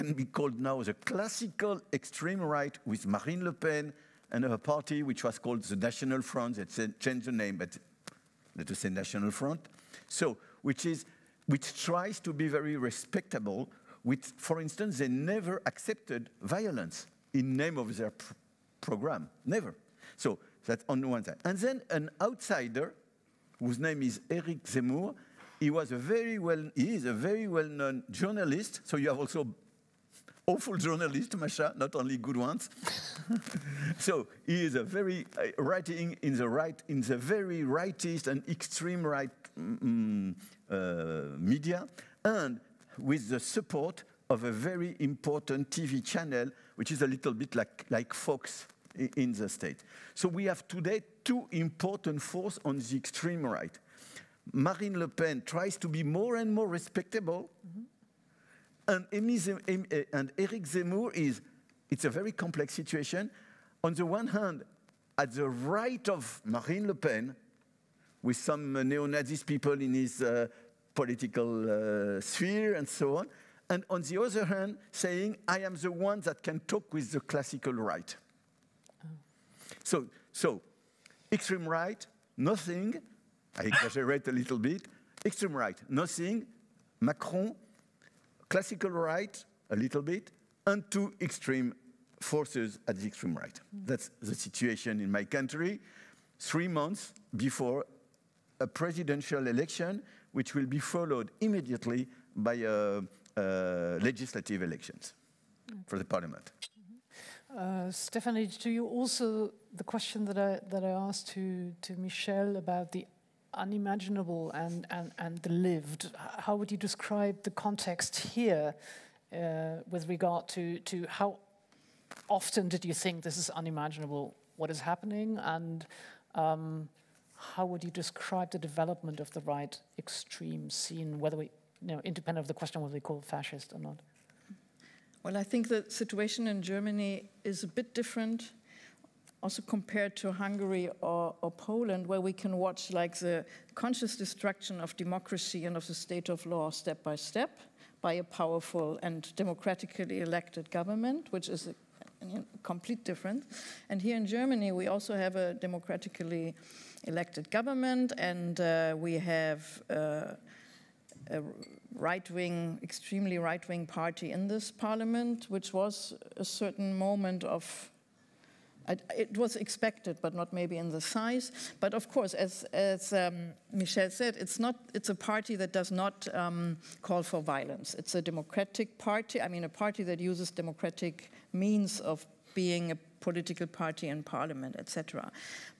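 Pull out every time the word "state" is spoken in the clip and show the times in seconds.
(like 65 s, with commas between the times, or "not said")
49 s, 145 s.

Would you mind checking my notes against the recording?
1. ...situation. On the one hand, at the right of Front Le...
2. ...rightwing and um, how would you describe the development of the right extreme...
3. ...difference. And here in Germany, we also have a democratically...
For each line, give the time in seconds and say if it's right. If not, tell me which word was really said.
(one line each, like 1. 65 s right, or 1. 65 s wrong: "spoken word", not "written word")
1. 62 s wrong: "Marine", not "Front"
2. 124 s wrong: "happening", not "rightwing"
3. 153 s right.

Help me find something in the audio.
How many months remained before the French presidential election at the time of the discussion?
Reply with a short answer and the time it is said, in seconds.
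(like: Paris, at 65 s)
3, at 96 s.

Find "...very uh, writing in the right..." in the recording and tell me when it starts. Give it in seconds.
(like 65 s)
34 s.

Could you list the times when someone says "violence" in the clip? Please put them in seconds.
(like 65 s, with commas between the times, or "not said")
16 s, 177 s.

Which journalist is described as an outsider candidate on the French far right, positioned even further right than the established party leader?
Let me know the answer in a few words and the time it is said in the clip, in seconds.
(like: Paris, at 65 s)
Eric Zemmour, at 24 s.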